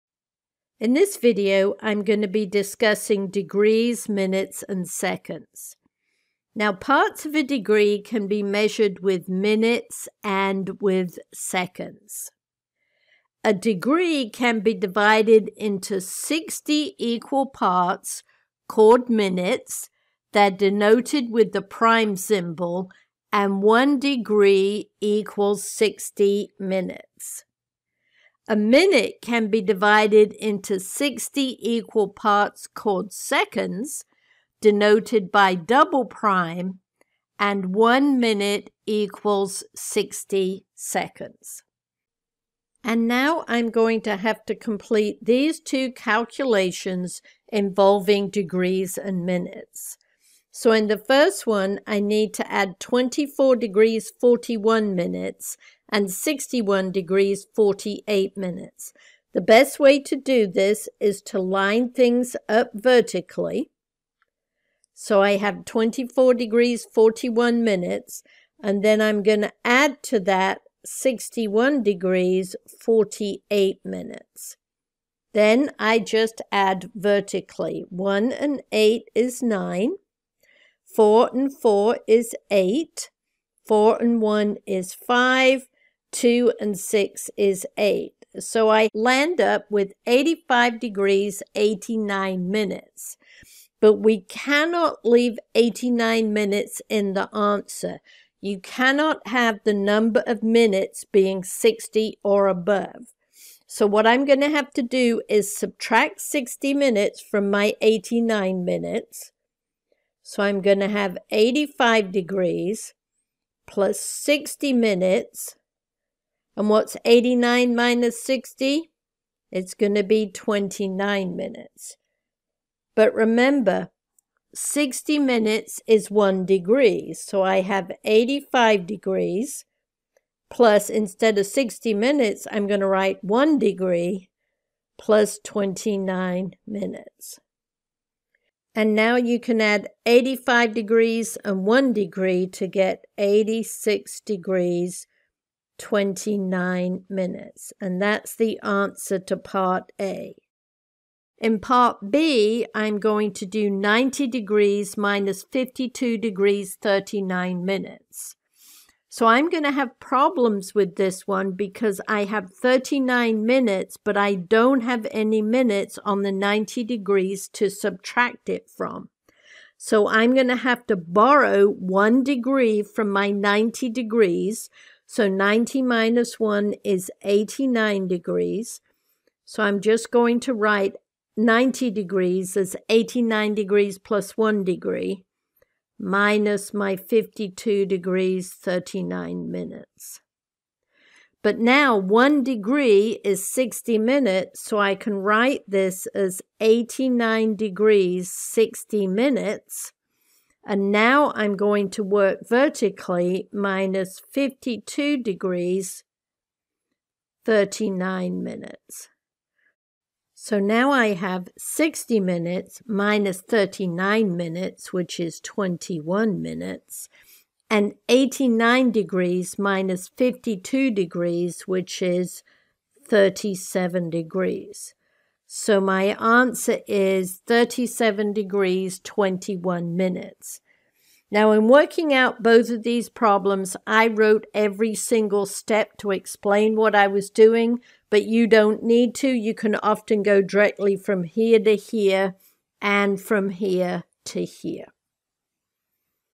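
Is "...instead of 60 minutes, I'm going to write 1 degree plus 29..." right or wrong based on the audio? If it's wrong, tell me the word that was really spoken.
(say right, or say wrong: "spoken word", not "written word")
right.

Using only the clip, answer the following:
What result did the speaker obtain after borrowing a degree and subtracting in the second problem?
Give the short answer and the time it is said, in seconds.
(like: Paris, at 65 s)
37 degrees 21 minutes, at 227 s.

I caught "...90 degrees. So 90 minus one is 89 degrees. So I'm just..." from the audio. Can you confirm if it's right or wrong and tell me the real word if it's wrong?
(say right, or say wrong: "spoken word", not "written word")
right.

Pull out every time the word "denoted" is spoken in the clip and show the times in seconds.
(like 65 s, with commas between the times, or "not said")
20 s, 34 s.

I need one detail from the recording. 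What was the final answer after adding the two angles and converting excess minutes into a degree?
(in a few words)
86 degrees 29 minutes.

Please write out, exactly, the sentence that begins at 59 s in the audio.
The best way to do this is to line things up vertically.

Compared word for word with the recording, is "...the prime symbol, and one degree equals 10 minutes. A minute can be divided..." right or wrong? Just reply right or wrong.
wrong.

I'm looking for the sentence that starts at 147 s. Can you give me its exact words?
And that's the answer to part A.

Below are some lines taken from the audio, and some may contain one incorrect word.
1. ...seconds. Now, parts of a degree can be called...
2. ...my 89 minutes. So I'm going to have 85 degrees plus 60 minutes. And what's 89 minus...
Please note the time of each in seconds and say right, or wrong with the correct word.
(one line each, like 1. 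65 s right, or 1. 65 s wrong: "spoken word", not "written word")
1. 4 s wrong: "measured", not "called"
2. 107 s right.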